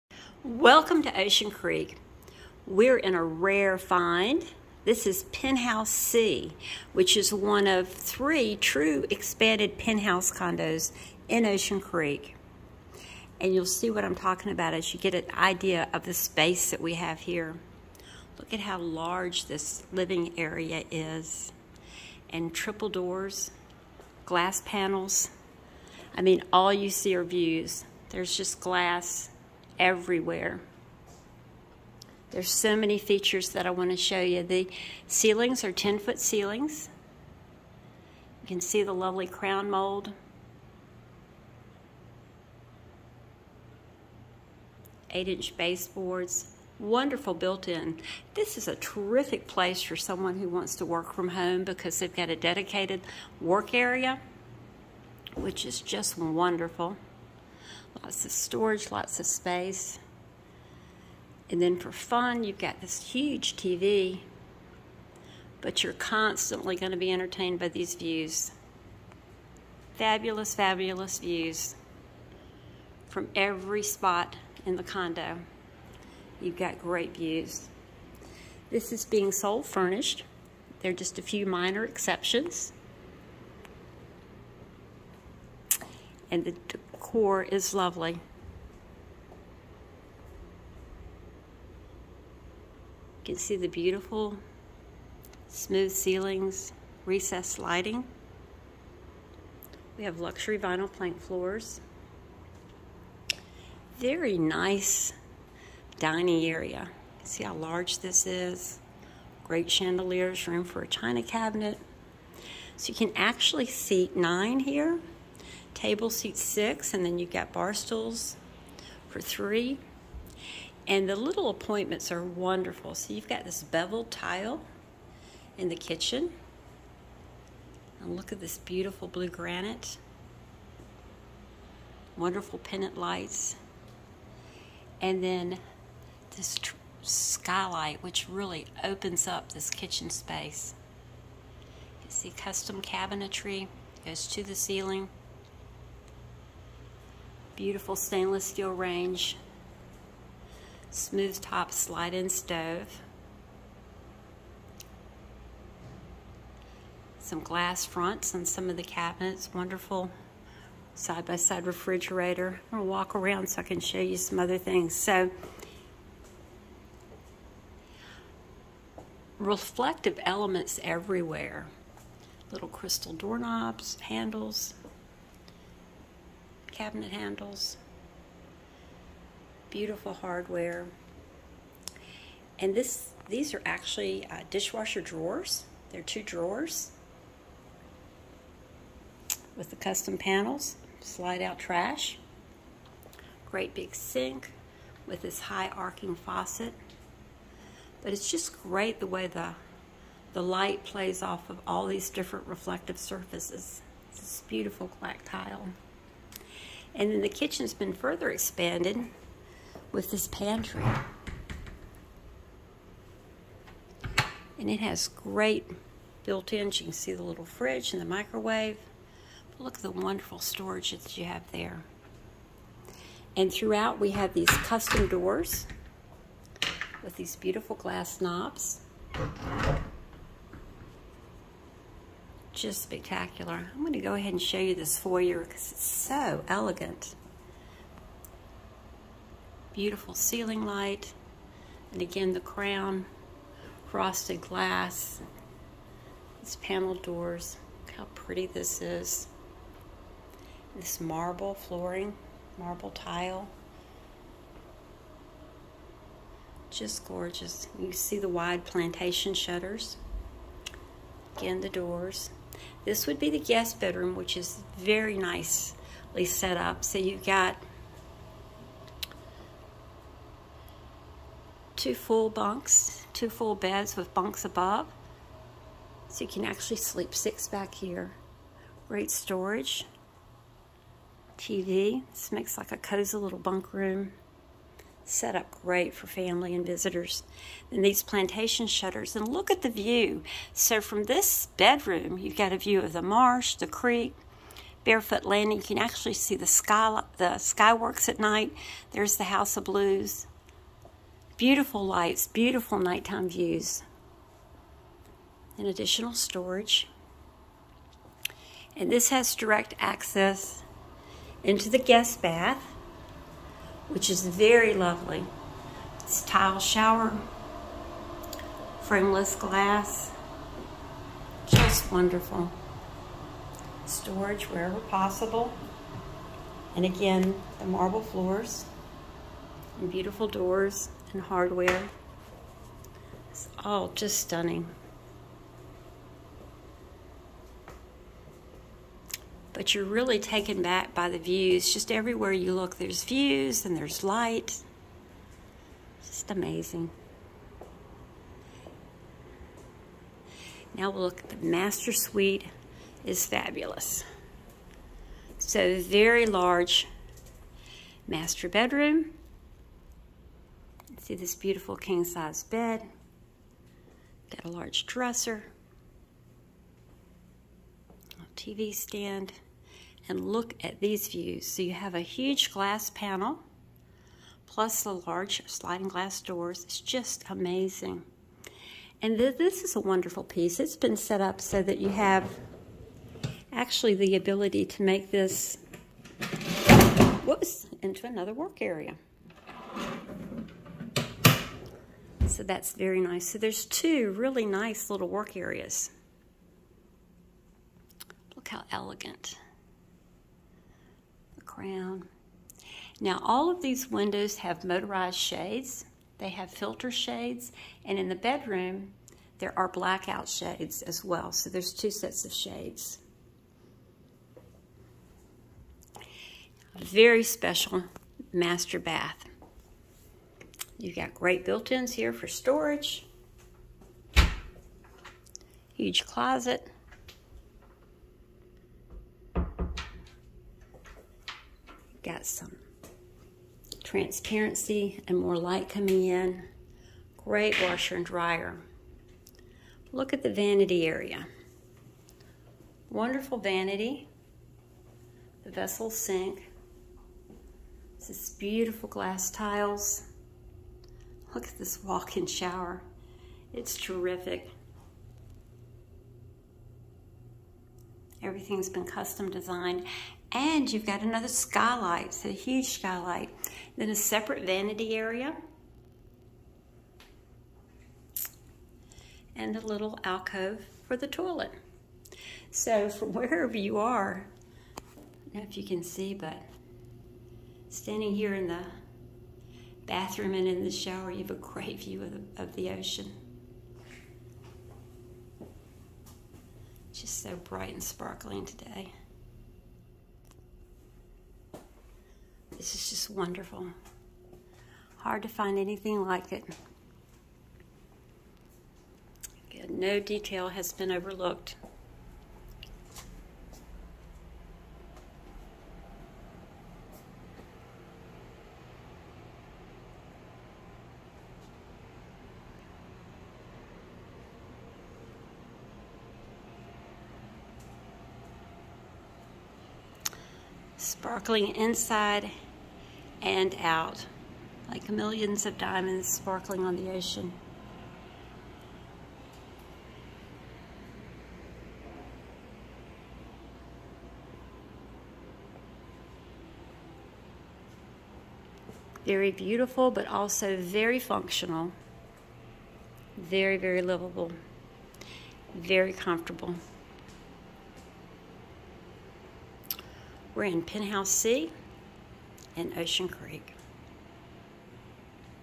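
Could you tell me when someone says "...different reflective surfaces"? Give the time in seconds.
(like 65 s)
202 s.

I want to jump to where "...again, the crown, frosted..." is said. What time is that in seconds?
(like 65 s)
242 s.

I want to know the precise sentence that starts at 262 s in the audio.
This would be the guest bedroom, which is very nicely set up.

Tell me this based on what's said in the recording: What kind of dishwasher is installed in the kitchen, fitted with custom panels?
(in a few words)
dishwasher drawers.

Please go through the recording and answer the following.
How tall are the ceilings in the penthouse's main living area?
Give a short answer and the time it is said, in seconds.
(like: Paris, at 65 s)
10-foot, at 35 s.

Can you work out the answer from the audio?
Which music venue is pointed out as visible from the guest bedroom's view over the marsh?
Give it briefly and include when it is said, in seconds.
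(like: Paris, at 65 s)
House of Blues, at 299 s.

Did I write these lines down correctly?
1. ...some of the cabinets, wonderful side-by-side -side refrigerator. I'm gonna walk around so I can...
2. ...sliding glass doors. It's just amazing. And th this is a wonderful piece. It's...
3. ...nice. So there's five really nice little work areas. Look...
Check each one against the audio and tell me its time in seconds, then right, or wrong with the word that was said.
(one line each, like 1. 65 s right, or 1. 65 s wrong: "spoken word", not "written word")
1. 158 s right
2. 375 s right
3. 392 s wrong: "two", not "five".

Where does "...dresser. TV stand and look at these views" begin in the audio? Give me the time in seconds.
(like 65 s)
364 s.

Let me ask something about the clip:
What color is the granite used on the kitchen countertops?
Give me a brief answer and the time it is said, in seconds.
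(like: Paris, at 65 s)
blue, at 129 s.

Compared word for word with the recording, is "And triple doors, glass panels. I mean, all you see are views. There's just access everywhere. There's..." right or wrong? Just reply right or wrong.
wrong.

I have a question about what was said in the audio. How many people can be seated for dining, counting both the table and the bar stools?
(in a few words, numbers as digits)
9.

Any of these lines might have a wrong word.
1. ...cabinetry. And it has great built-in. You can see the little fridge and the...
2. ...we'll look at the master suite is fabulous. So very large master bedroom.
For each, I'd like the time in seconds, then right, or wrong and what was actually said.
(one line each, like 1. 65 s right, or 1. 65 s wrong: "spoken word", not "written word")
1. 210 s wrong: "pantry", not "cabinetry"
2. 350 s right.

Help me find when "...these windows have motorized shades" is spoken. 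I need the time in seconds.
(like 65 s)
403 s.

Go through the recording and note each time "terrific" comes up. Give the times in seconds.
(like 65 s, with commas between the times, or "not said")
48 s, 453 s.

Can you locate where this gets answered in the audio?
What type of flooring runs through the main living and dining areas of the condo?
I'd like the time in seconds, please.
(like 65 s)
100 s.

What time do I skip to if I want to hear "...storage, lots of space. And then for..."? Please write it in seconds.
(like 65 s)
58 s.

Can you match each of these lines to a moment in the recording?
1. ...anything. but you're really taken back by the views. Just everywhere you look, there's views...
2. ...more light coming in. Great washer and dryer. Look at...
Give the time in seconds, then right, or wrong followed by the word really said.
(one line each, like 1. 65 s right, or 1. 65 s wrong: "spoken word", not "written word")
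1. 334 s wrong: "stunning", not "anything"
2. 435 s right.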